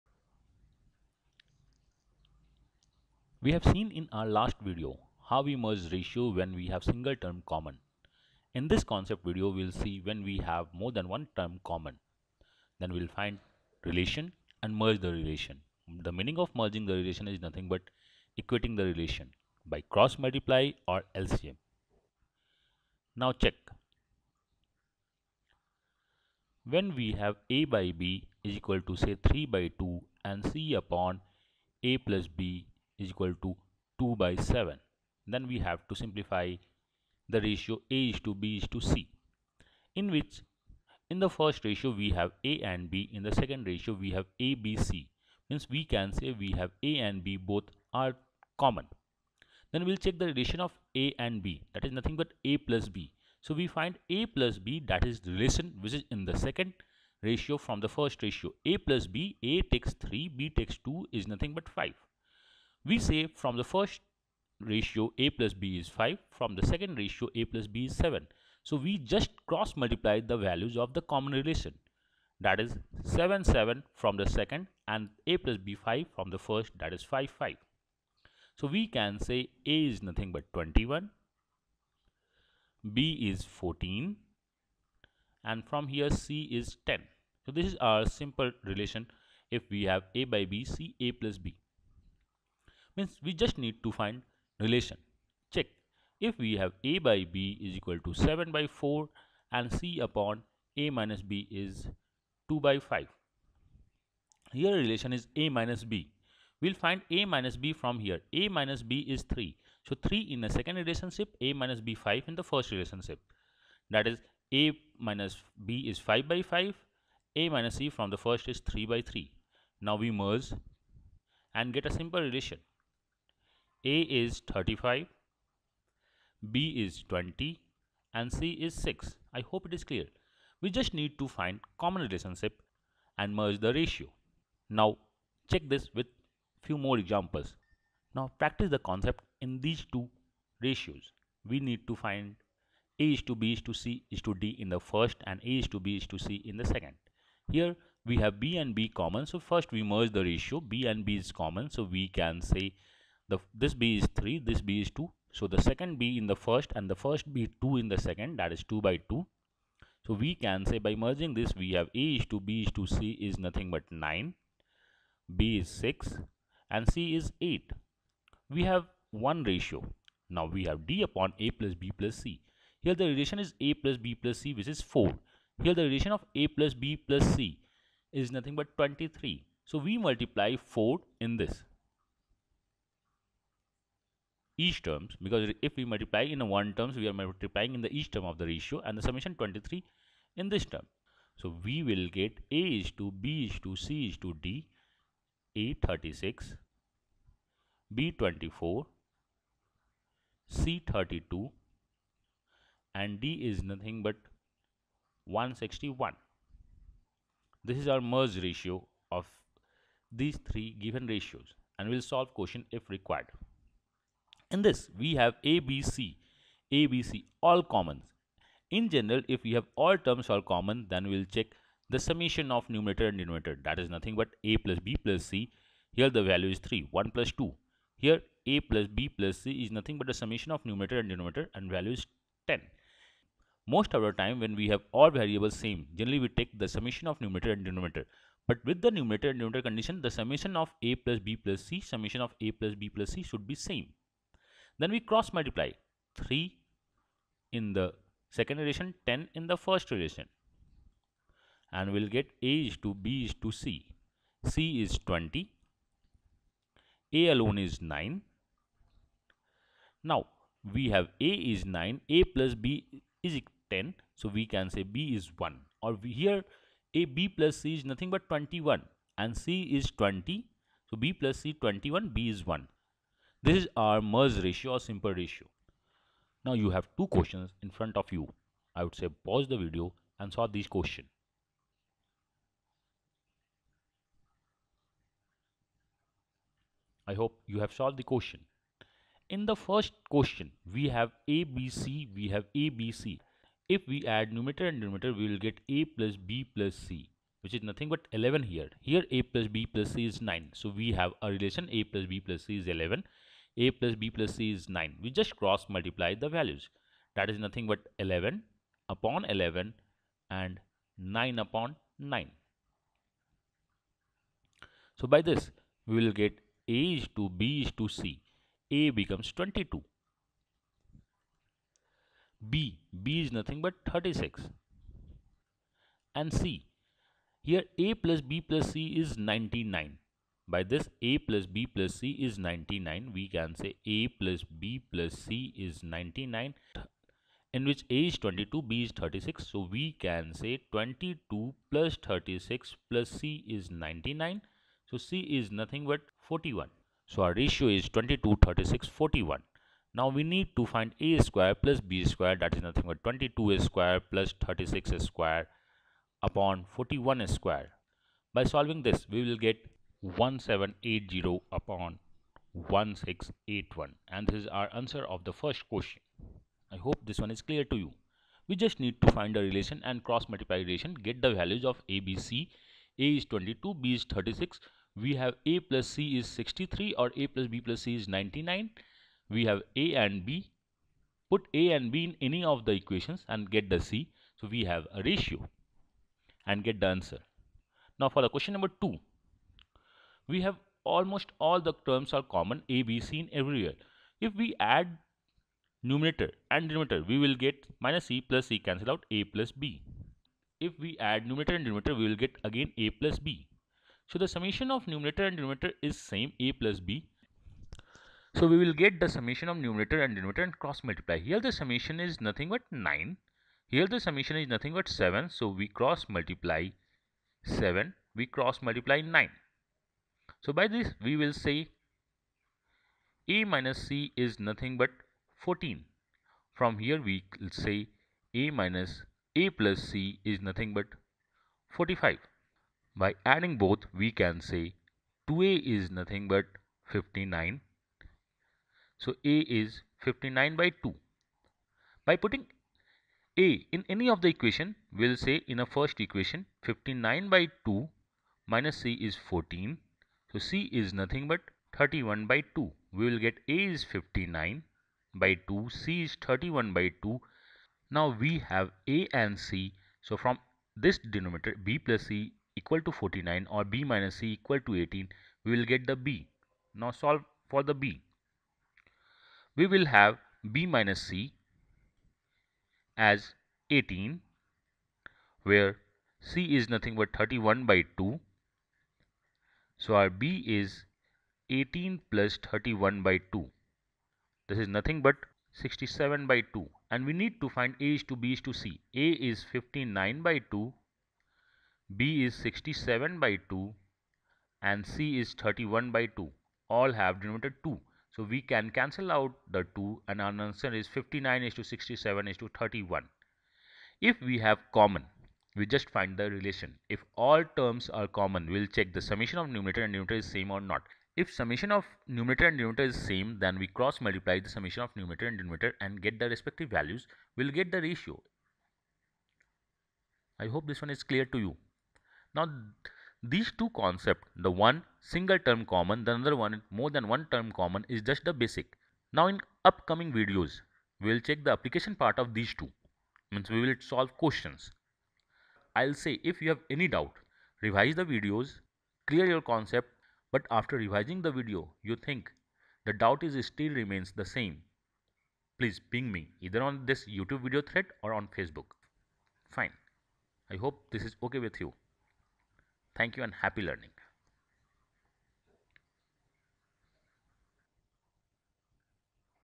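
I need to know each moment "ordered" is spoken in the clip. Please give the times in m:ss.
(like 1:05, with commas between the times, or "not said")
not said.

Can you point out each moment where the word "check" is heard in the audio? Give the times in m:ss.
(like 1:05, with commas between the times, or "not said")
0:23, 0:50, 1:35, 2:15, 3:41, 8:28, 8:51.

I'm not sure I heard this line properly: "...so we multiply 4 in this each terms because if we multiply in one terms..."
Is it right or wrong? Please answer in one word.
right.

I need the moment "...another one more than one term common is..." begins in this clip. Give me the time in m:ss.
8:46.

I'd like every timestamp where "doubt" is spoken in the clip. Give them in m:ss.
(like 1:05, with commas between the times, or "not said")
8:56, 9:02.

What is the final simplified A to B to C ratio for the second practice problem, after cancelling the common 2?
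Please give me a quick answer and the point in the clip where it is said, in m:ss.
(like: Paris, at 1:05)
59:67:31, at 8:20.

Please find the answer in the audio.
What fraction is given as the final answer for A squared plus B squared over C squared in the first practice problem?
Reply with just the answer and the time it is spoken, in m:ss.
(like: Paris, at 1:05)
1780/1681, at 6:00.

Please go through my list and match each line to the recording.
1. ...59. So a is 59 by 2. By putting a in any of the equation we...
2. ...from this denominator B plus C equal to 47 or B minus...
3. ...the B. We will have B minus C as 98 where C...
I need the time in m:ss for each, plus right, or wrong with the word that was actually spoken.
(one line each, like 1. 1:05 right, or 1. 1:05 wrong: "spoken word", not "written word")
1. 7:16 right
2. 7:40 wrong: "49", not "47"
3. 7:47 wrong: "18", not "98".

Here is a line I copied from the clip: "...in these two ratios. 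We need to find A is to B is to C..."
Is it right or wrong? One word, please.
right.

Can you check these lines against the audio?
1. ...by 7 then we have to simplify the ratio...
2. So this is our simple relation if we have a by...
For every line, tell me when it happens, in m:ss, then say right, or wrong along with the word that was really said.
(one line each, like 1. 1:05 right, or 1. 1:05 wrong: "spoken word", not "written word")
1. 0:34 right
2. 1:27 right.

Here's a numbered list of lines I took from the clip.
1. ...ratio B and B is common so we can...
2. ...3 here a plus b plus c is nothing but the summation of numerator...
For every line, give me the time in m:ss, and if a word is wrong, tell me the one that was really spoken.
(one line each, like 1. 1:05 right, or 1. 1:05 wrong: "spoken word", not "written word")
1. 2:30 right
2. 3:47 wrong: "2", not "3".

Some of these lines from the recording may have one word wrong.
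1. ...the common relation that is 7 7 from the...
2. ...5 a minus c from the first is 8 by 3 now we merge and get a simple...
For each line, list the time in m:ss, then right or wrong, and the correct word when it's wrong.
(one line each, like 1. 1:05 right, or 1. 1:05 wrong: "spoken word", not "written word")
1. 1:10 right
2. 1:56 wrong: "3", not "8".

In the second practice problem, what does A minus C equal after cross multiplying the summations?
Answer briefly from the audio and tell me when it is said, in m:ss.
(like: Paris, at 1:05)
14, at 7:03.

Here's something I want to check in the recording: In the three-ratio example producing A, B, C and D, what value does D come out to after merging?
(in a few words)
161.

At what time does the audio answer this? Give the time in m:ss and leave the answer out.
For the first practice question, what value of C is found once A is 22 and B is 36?
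5:44.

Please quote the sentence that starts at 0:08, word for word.
In this concept video, we'll see when we have more than one term common.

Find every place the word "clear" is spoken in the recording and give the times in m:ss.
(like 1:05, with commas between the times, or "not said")
2:09, 6:07, 8:41, 8:59.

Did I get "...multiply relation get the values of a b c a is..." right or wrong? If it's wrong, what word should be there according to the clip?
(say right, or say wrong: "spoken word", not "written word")
right.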